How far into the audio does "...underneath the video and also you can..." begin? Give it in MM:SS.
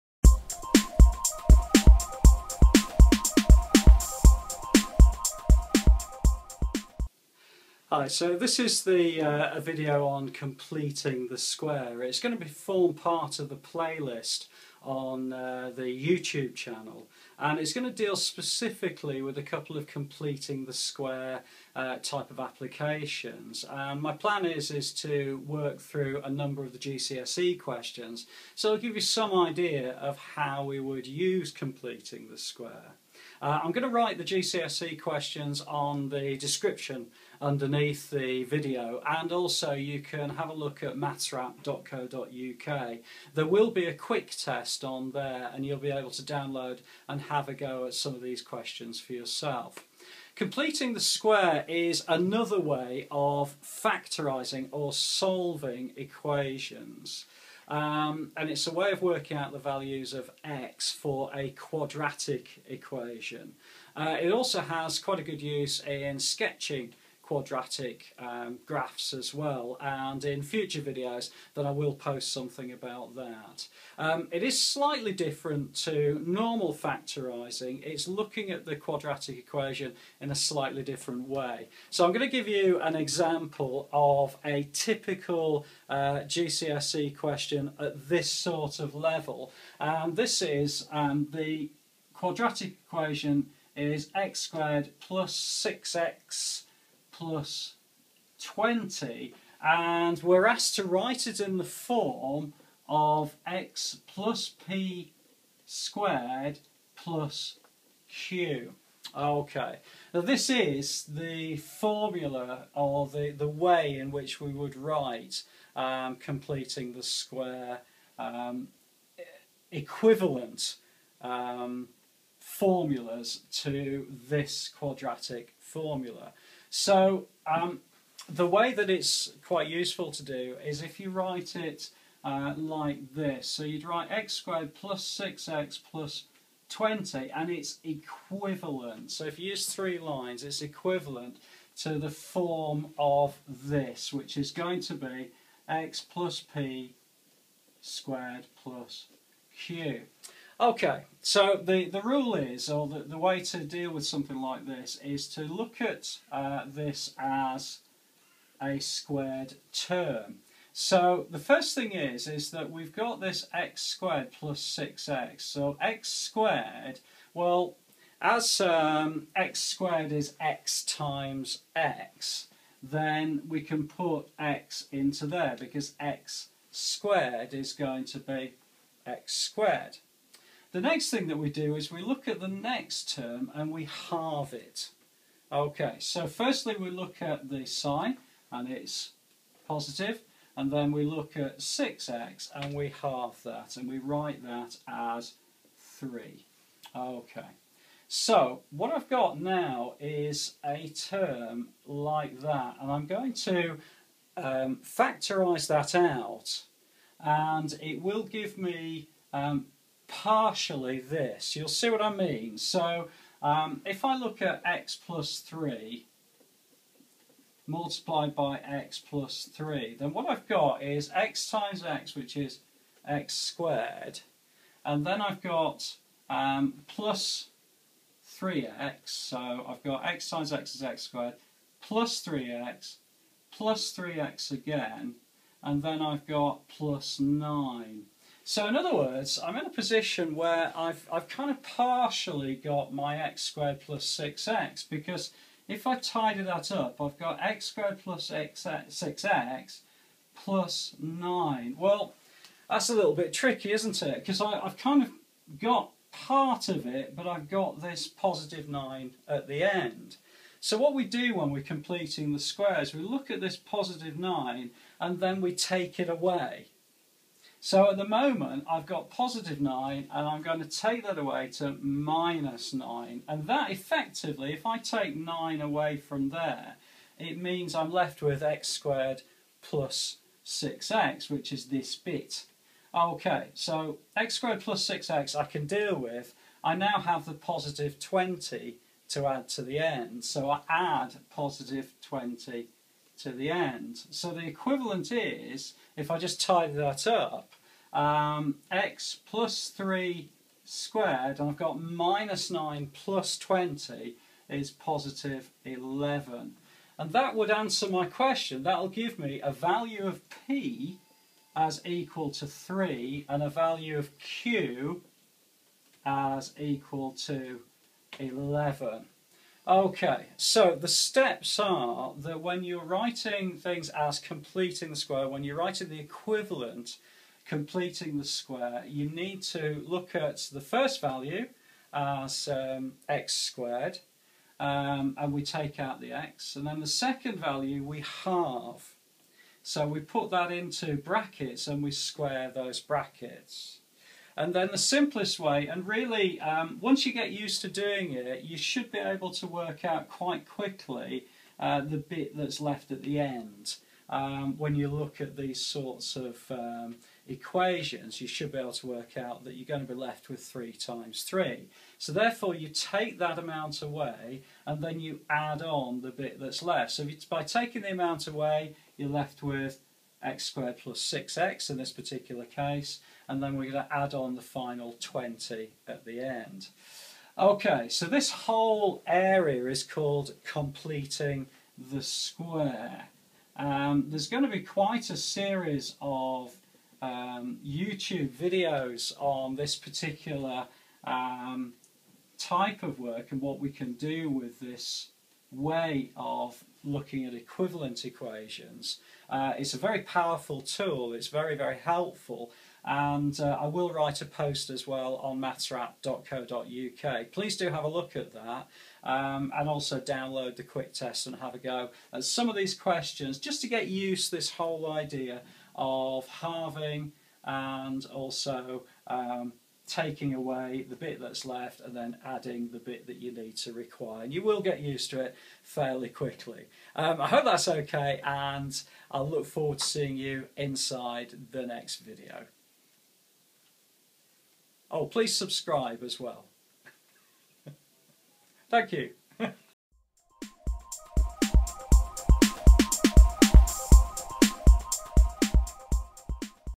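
00:37.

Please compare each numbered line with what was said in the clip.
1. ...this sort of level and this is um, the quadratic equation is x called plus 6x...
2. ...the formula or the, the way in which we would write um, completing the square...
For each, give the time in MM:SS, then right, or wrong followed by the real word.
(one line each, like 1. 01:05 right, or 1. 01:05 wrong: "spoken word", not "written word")
1. 01:28 wrong: "squared", not "called"
2. 01:51 right.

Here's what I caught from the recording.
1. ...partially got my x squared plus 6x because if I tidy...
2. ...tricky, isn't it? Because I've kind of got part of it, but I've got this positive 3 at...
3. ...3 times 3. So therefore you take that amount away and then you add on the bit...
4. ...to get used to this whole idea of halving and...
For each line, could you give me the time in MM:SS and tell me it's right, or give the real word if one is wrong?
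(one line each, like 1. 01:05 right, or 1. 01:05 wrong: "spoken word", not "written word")
1. 04:01 right
2. 04:13 wrong: "9", not "3"
3. 06:00 right
4. 06:53 right.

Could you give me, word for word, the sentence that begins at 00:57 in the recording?
Um, and it's a way of working out the values of x for a quadratic equation.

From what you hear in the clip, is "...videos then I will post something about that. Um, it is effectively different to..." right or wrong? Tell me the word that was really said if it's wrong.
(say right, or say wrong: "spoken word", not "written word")
wrong: "slightly", not "effectively".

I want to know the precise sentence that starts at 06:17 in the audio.
Okay, so this whole area is called completing the square.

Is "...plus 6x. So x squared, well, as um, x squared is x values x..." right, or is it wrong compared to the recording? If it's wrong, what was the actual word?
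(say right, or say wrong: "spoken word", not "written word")
wrong: "times", not "values".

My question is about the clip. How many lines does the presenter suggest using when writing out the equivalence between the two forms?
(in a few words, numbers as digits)
3.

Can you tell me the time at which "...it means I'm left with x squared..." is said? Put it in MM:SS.
04:37.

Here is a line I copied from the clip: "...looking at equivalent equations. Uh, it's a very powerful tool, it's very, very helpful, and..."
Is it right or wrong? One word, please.
right.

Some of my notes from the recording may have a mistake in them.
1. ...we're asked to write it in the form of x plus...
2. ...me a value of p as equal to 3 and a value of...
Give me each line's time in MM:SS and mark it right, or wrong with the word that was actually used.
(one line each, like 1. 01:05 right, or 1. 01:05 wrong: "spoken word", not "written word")
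1. 01:40 right
2. 05:09 right.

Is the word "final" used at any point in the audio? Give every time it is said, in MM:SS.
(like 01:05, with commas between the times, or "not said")
06:14.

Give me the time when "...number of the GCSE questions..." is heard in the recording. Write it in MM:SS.
00:26.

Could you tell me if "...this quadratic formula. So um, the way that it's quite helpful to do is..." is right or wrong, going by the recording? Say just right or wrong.
wrong.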